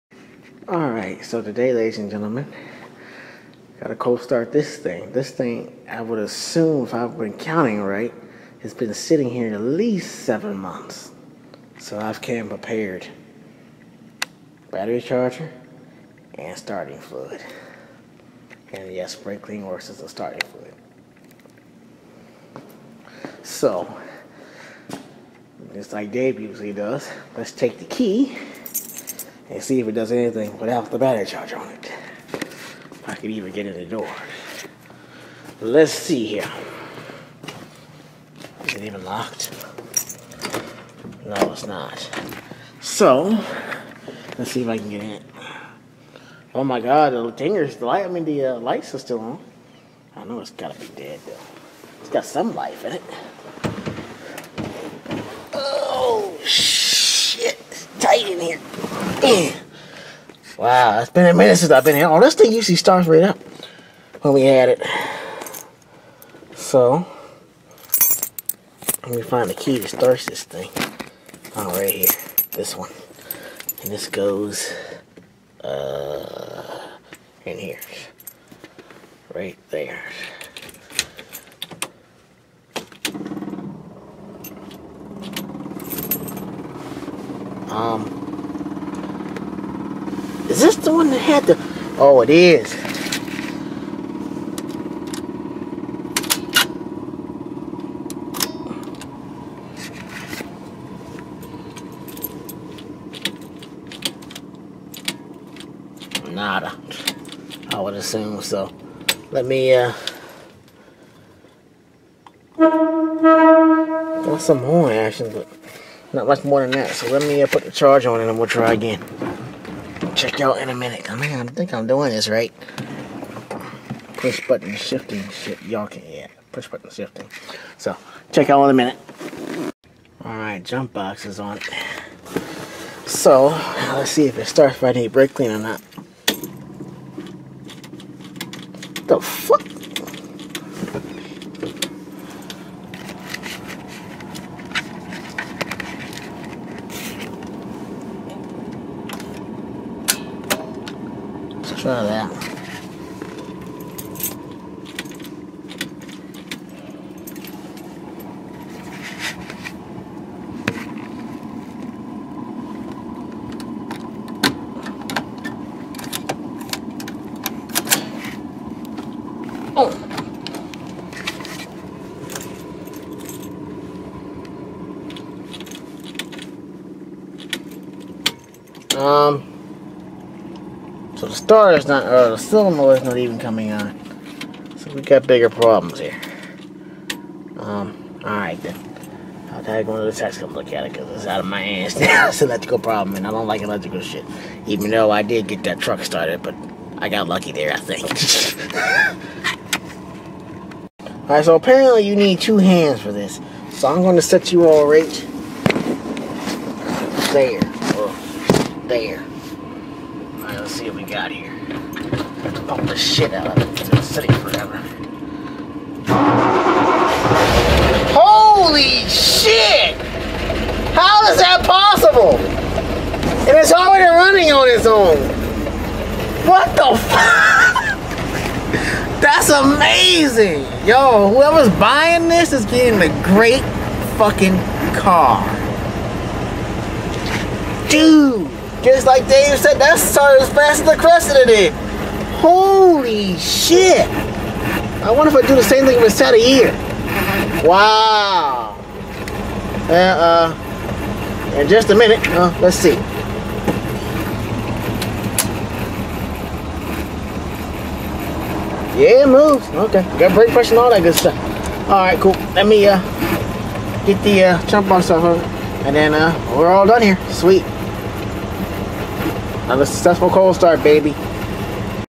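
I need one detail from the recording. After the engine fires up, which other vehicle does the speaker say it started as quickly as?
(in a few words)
The Crescent.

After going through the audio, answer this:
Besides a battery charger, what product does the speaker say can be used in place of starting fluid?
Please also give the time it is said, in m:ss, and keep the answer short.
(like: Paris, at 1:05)
Spray clean, at 0:19.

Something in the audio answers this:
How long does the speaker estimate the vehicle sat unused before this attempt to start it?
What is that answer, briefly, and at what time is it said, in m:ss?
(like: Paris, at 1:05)
7 months, at 0:10.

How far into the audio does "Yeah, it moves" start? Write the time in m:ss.
4:18.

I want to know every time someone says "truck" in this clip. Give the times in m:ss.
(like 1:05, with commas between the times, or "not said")
3:15.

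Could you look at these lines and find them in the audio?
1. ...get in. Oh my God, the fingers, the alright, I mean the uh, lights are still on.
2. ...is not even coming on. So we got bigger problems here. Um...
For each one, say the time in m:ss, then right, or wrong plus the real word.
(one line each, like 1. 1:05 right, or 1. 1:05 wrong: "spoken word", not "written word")
1. 0:44 wrong: "light", not "alright"
2. 3:02 right.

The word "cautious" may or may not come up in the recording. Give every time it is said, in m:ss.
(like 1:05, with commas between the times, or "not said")
not said.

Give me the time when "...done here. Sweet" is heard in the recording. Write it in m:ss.
4:26.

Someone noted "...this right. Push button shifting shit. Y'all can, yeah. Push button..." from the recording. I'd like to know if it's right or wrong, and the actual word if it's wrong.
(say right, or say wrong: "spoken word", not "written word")
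right.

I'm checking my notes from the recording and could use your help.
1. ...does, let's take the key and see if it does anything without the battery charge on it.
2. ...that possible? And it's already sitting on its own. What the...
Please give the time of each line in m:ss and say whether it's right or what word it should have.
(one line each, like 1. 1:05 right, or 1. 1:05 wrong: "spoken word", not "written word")
1. 0:26 right
2. 3:41 wrong: "running", not "sitting".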